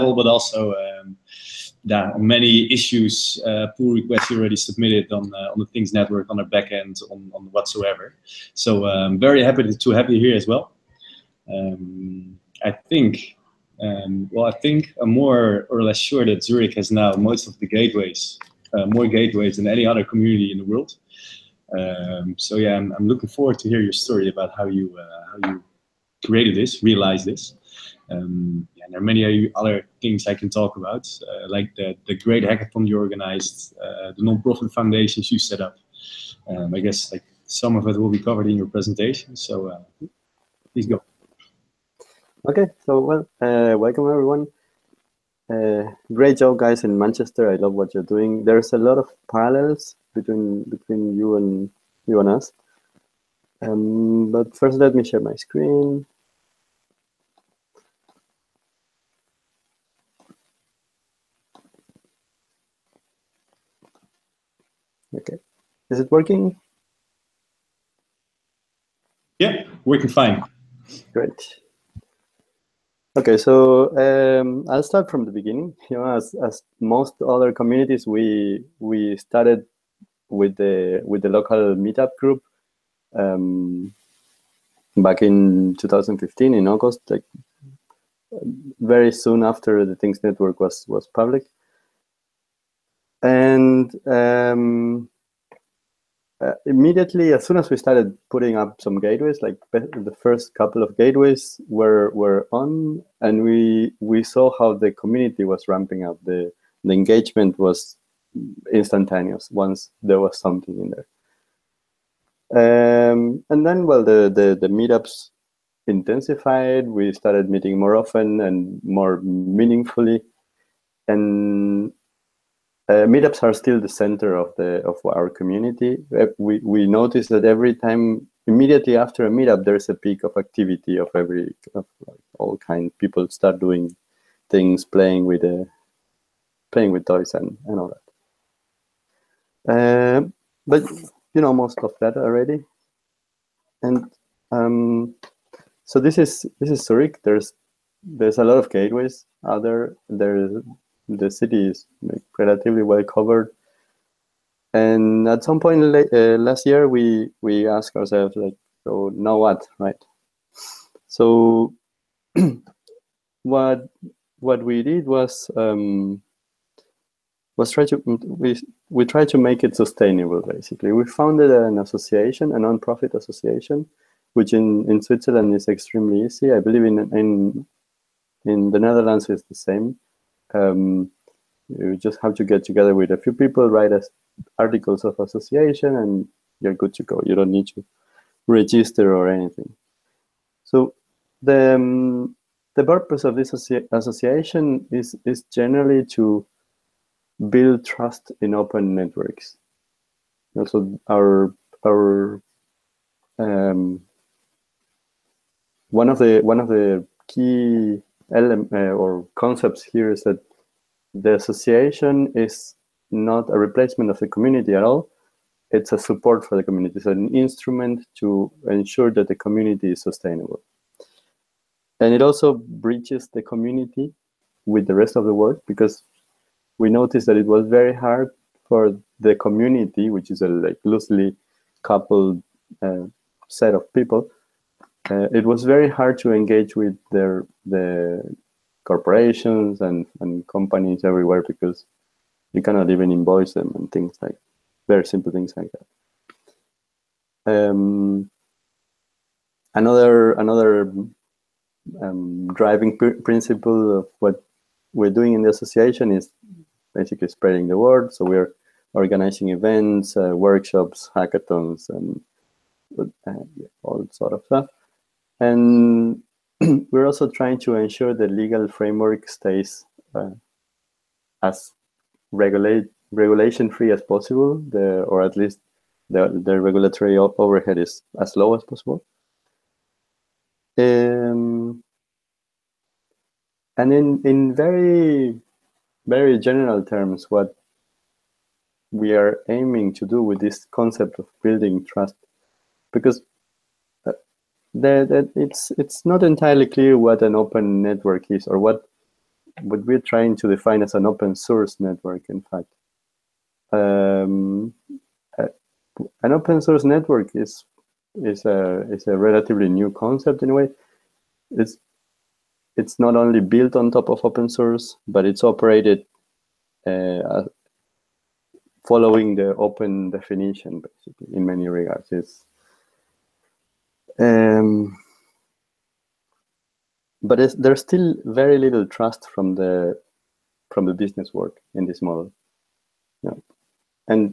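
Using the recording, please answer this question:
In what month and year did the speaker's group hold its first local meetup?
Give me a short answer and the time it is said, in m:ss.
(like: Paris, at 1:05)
August 2015, at 1:25.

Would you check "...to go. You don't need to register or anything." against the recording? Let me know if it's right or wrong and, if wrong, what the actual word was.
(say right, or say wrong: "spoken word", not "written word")
right.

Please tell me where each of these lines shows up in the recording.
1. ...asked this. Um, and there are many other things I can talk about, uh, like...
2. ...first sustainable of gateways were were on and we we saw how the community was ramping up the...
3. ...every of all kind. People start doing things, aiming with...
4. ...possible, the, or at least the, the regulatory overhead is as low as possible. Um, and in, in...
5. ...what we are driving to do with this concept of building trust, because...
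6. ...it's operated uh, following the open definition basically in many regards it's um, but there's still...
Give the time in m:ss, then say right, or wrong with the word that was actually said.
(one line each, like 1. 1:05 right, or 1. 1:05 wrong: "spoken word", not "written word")
1. 0:26 wrong: "realized", not "asked"
2. 1:40 wrong: "couple", not "sustainable"
3. 2:11 wrong: "playing", not "aiming"
4. 4:34 right
5. 4:47 wrong: "aiming", not "driving"
6. 5:15 right.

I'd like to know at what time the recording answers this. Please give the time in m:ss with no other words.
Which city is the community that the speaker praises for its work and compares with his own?
0:46.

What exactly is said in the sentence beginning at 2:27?
There's there's a lot of gateways Other There's the city is like, relatively well covered.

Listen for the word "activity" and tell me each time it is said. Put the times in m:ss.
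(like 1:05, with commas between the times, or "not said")
2:10.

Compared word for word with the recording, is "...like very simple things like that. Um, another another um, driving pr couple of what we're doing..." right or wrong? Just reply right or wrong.
wrong.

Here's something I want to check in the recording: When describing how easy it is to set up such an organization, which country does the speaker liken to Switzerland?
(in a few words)
Netherlands.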